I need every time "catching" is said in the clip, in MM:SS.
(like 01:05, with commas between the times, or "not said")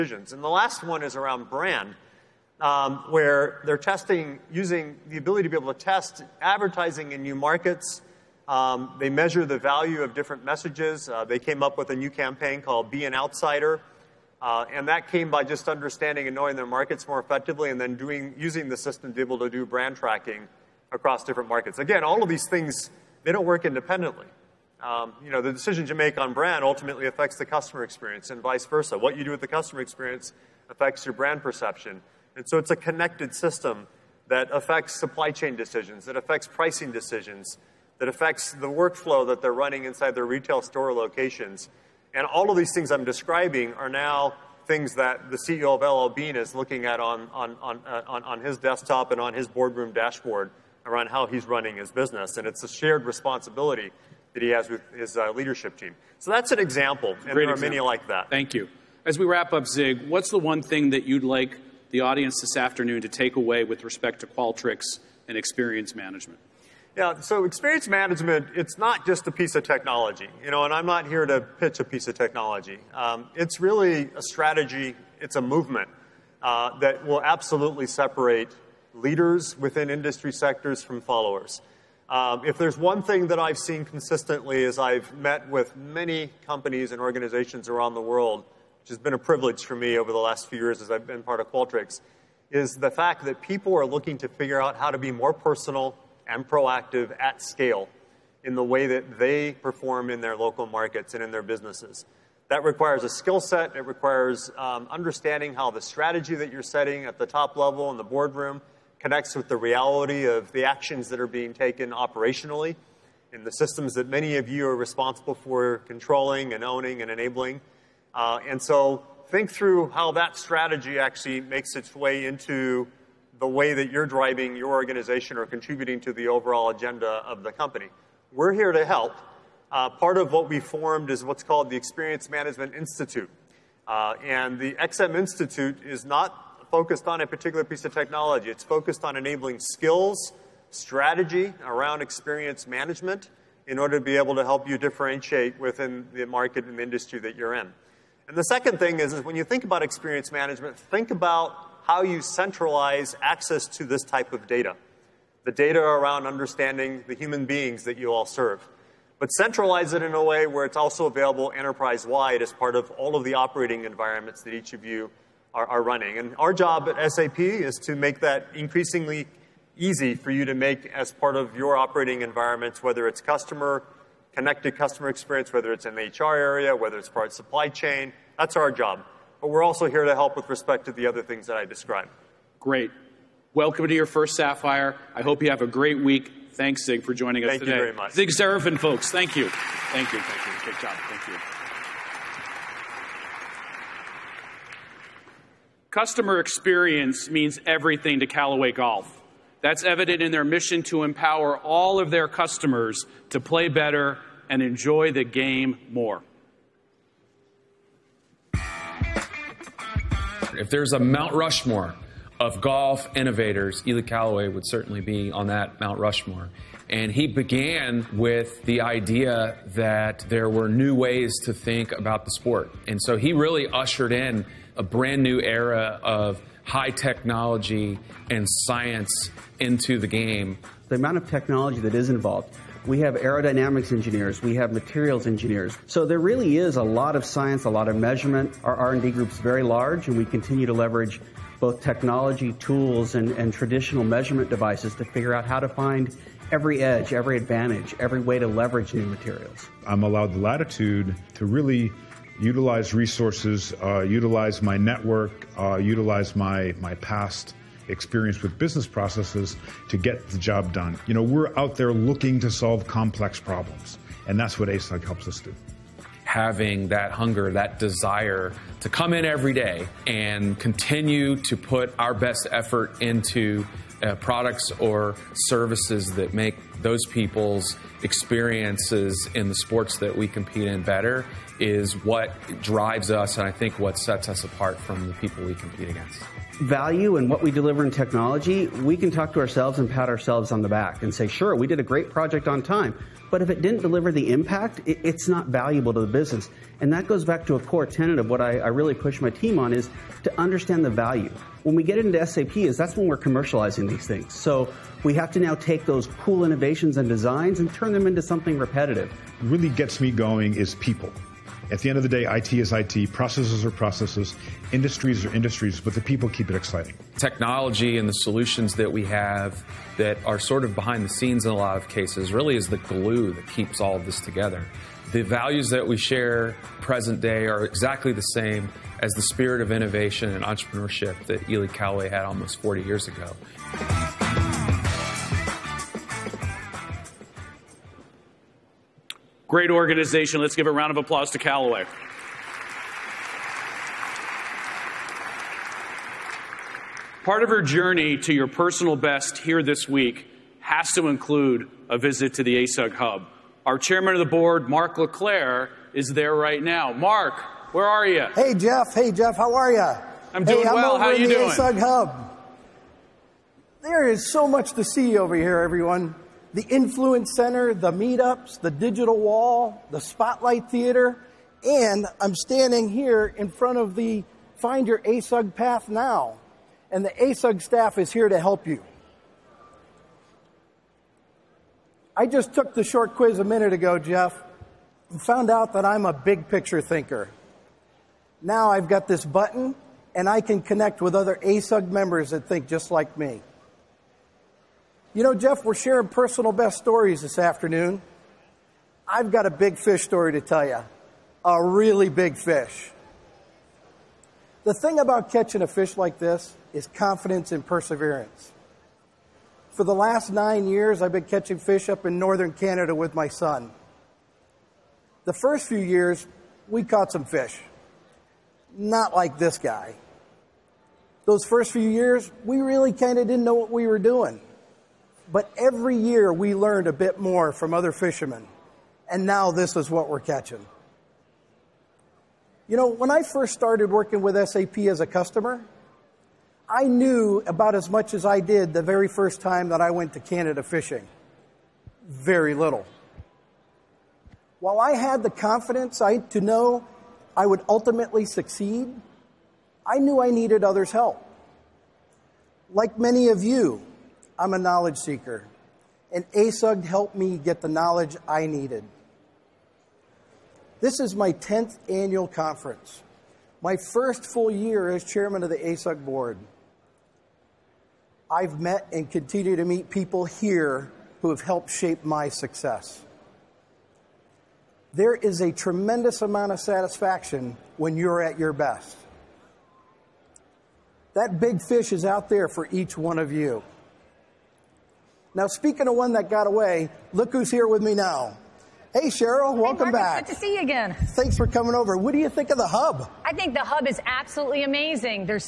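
06:45, 06:51, 07:10.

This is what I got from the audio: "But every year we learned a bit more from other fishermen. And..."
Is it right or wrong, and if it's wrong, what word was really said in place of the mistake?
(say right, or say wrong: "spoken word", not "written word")
right.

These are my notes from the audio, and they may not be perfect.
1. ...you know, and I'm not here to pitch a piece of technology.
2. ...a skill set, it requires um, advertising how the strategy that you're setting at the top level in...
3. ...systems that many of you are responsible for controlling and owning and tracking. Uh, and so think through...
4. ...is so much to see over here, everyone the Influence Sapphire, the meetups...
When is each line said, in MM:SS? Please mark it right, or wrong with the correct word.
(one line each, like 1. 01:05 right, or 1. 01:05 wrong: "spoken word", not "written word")
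1. 01:10 right
2. 01:43 wrong: "understanding", not "advertising"
3. 01:53 wrong: "enabling", not "tracking"
4. 06:04 wrong: "Center", not "Sapphire".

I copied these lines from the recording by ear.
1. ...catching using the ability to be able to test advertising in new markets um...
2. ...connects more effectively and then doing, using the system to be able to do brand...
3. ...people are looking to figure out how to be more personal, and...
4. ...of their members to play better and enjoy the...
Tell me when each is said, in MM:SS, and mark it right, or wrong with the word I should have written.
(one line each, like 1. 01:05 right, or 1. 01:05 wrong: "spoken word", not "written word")
1. 00:03 wrong: "testing", not "catching"
2. 00:16 wrong: "markets", not "connects"
3. 01:33 right
4. 03:21 wrong: "customers", not "members".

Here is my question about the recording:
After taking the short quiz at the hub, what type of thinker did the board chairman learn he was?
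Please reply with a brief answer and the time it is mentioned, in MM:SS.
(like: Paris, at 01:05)
big picture thinker, at 06:26.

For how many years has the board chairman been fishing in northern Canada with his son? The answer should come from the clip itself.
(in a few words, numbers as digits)
9.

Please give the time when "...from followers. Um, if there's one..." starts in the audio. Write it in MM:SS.
01:20.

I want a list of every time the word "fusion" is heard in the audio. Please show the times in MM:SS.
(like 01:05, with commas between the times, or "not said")
not said.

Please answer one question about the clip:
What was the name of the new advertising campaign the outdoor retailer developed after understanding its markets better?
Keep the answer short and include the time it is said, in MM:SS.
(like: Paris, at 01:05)
Be an Outsider, at 00:12.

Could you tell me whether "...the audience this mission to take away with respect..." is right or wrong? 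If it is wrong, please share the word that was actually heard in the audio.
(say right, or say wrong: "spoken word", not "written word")
wrong: "afternoon", not "mission".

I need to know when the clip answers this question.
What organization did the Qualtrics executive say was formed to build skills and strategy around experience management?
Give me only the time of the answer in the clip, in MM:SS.
02:11.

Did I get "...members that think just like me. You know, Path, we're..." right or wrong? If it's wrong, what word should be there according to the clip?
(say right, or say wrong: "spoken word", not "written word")
wrong: "Jeff", not "Path".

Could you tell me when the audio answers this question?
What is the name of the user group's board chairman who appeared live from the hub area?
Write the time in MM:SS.
05:54.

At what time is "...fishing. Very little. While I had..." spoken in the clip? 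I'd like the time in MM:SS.
07:20.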